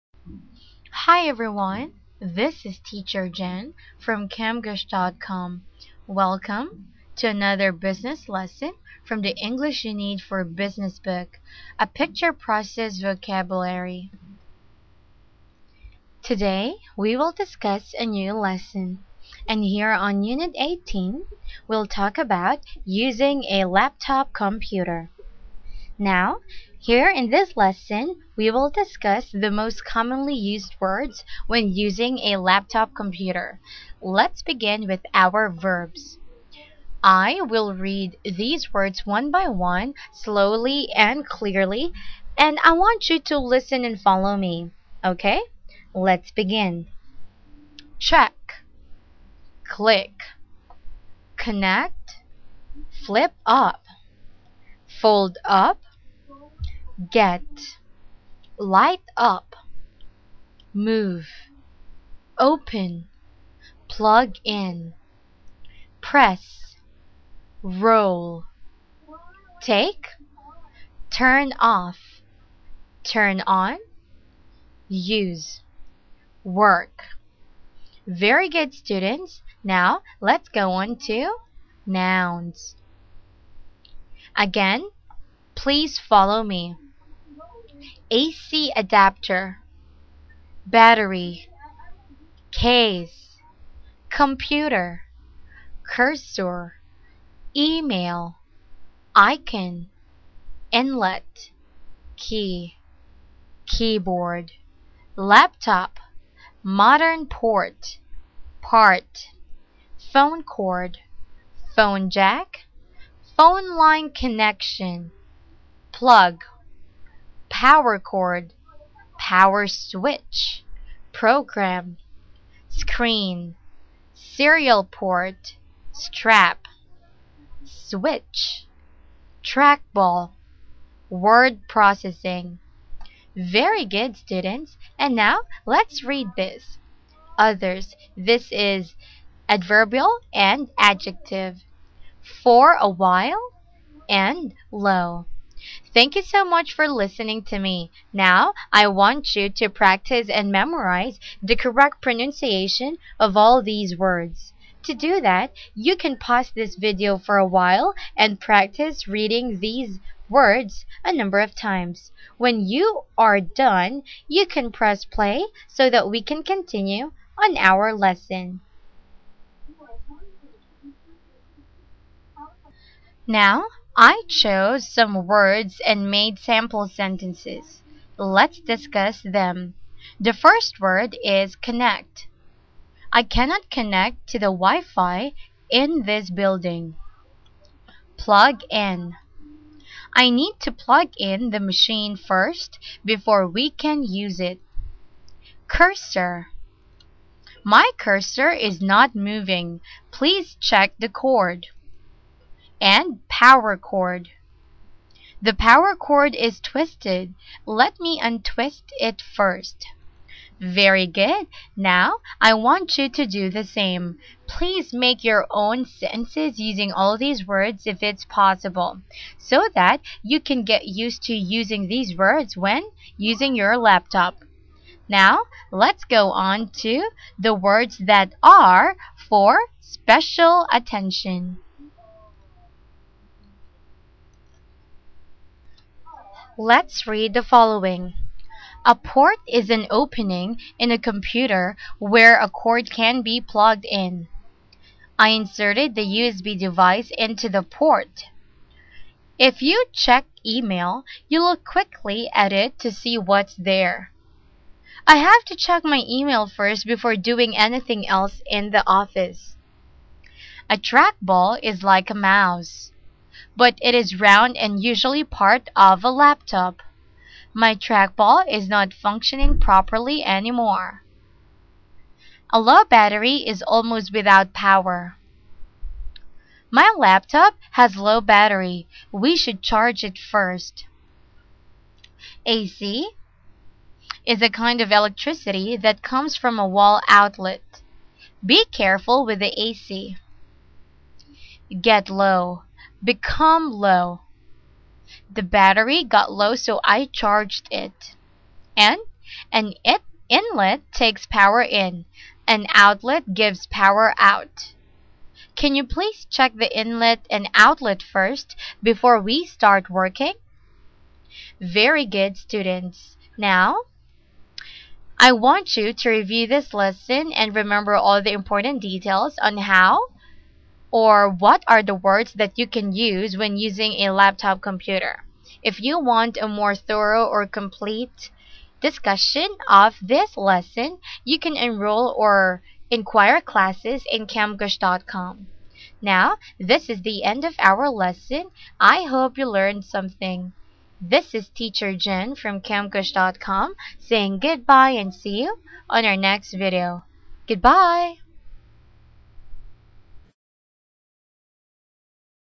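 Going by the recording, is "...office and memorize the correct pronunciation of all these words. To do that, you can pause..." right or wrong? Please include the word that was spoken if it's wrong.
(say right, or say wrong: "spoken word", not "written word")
wrong: "practice", not "office".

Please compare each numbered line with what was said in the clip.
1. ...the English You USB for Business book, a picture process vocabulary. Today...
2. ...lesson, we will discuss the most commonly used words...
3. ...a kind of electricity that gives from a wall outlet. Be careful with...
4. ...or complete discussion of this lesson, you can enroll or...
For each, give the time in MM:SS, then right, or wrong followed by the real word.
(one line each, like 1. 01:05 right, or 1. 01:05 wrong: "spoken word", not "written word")
1. 00:09 wrong: "Need", not "USB"
2. 00:27 right
3. 04:44 wrong: "comes", not "gives"
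4. 05:27 right.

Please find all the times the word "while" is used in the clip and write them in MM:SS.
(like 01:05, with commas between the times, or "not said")
02:22, 02:37.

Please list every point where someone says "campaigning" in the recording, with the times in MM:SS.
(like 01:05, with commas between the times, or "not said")
not said.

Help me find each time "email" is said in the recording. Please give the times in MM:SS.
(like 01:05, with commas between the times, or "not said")
01:37, 04:10, 04:16.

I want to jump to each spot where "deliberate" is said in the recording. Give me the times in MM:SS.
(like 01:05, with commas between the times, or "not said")
not said.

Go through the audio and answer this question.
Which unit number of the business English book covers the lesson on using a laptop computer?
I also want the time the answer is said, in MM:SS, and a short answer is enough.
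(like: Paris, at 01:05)
18, at 00:20.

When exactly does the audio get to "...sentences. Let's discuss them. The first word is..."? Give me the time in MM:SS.
02:56.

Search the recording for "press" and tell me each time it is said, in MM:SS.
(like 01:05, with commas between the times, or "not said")
01:06, 02:44.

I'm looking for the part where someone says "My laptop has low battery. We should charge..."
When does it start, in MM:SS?
04:36.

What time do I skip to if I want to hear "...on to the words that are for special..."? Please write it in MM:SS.
03:46.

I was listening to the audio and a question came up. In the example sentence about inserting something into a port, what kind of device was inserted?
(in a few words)
USB device.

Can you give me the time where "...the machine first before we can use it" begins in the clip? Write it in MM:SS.
03:11.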